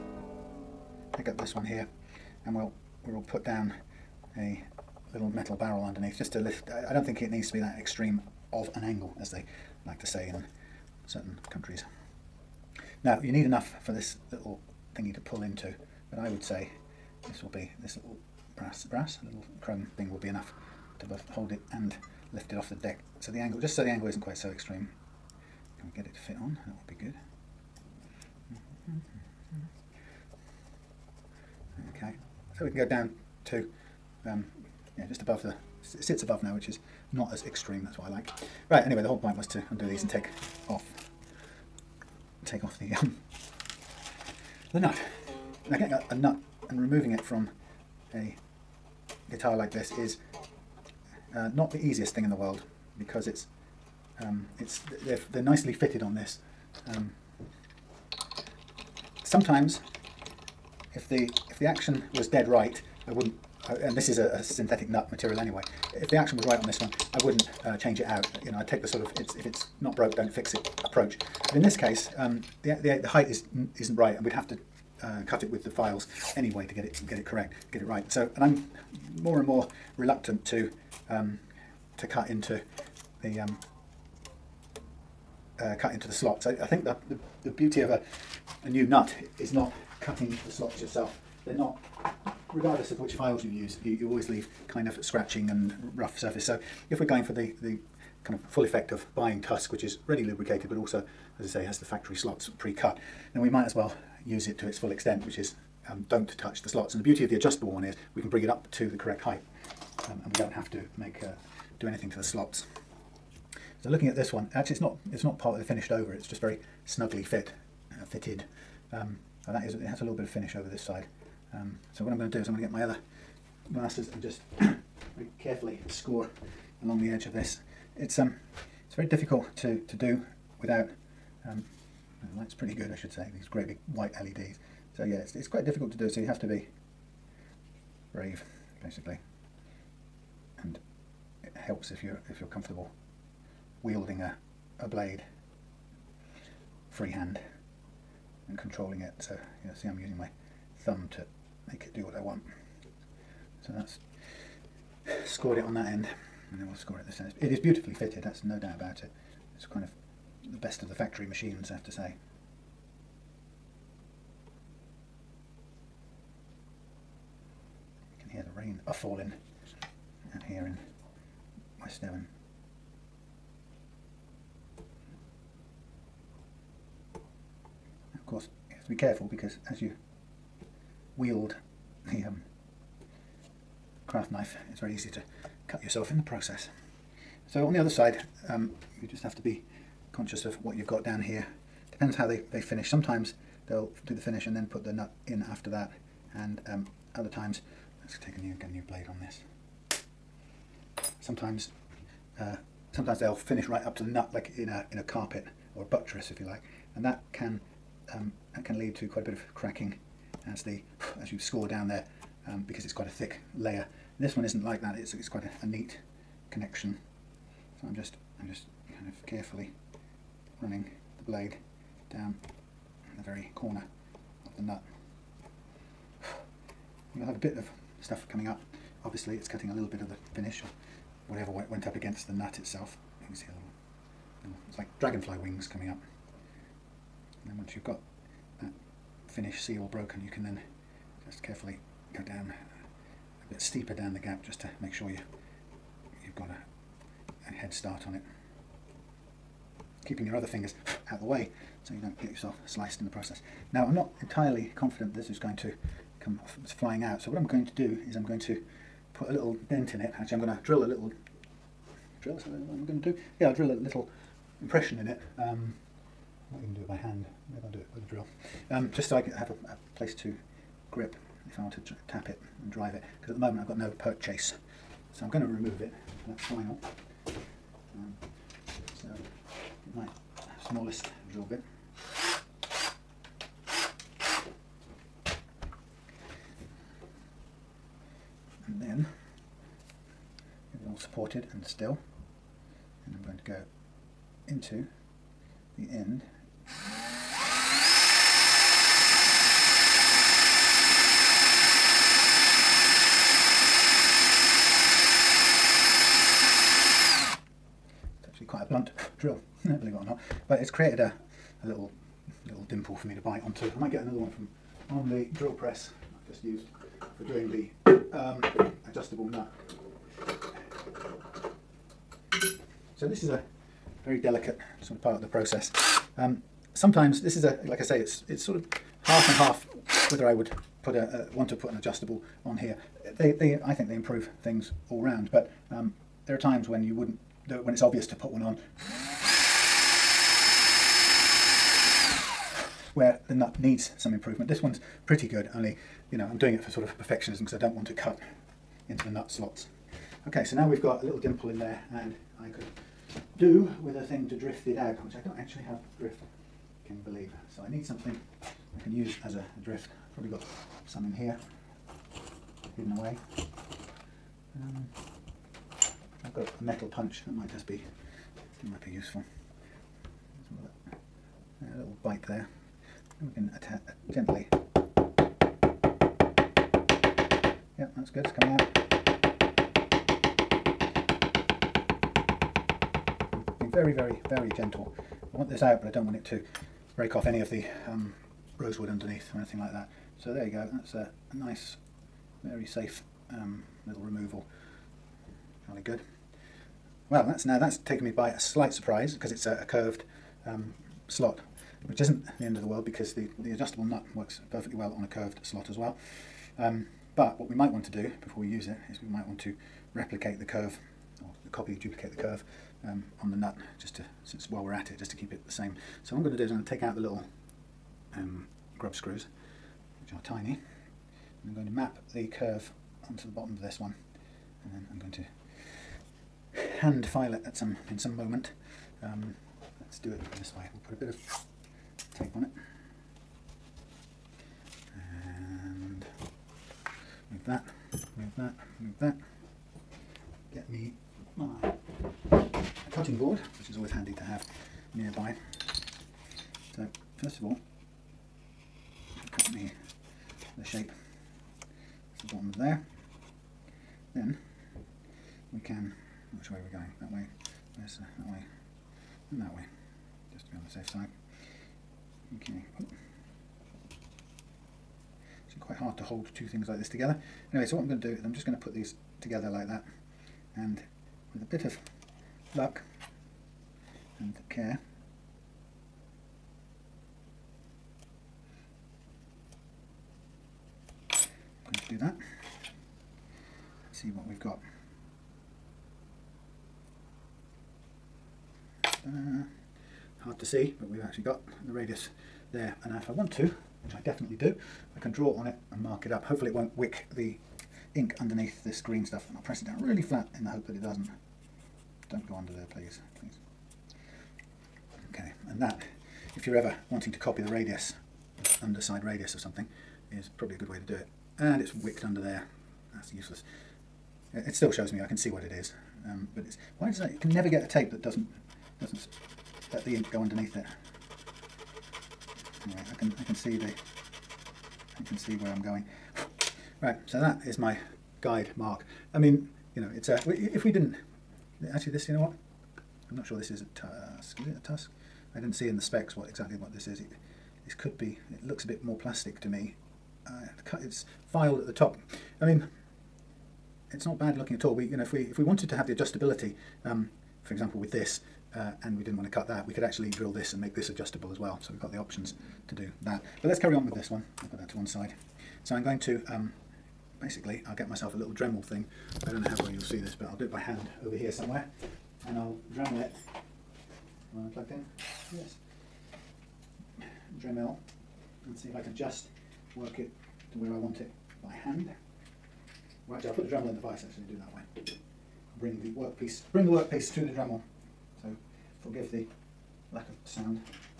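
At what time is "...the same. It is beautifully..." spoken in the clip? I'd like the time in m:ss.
2:37.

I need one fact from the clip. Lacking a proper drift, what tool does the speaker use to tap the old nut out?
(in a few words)
metal punch.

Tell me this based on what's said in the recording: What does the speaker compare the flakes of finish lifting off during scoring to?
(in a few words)
dragonfly wings.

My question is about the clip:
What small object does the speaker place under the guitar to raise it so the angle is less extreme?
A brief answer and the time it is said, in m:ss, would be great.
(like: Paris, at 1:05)
little metal barrel, at 0:05.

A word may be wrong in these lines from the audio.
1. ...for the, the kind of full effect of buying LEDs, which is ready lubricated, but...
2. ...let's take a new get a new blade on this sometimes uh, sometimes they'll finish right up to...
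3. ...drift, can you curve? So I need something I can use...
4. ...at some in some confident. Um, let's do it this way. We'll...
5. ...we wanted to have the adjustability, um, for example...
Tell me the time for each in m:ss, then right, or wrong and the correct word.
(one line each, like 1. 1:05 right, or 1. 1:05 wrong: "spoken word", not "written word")
1. 1:37 wrong: "Tusq", not "LEDs"
2. 3:18 right
3. 5:55 wrong: "believe", not "curve"
4. 7:07 wrong: "moment", not "confident"
5. 9:05 right.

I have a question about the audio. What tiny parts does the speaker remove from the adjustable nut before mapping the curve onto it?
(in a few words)
grub screws.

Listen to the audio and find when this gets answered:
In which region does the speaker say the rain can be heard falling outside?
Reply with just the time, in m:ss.
2:51.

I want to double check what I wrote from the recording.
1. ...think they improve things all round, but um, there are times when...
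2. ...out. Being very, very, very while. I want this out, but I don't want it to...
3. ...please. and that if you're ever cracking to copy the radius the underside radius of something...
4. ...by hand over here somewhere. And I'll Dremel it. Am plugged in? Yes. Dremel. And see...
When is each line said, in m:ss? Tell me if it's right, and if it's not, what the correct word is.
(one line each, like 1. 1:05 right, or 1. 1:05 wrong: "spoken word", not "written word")
1. 5:33 right
2. 6:18 wrong: "gentle", not "while"
3. 8:22 wrong: "wanting", not "cracking"
4. 9:20 right.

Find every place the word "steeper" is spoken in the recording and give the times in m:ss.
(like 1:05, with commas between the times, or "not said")
4:03.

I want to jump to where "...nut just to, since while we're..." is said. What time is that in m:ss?
6:53.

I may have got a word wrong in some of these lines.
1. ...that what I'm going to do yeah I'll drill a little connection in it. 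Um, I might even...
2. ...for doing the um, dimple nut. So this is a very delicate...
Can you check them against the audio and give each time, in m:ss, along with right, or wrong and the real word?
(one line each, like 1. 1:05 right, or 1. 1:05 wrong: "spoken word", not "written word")
1. 4:22 wrong: "impression", not "connection"
2. 5:17 wrong: "adjustable", not "dimple".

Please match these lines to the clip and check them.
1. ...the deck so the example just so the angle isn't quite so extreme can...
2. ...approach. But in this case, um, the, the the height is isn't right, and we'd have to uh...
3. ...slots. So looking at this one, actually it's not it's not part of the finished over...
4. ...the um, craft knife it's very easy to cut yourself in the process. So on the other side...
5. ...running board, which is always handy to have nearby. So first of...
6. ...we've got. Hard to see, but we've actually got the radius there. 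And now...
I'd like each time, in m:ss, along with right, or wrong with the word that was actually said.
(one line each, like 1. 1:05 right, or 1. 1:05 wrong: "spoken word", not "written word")
1. 0:22 wrong: "angle", not "example"
2. 1:10 right
3. 1:52 right
4. 3:02 right
5. 7:22 wrong: "cutting", not "running"
6. 8:04 right.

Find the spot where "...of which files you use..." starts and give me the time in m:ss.
1:32.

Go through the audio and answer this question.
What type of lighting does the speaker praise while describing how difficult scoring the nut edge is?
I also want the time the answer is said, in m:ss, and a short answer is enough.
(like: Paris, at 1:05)
white LEDs, at 2:13.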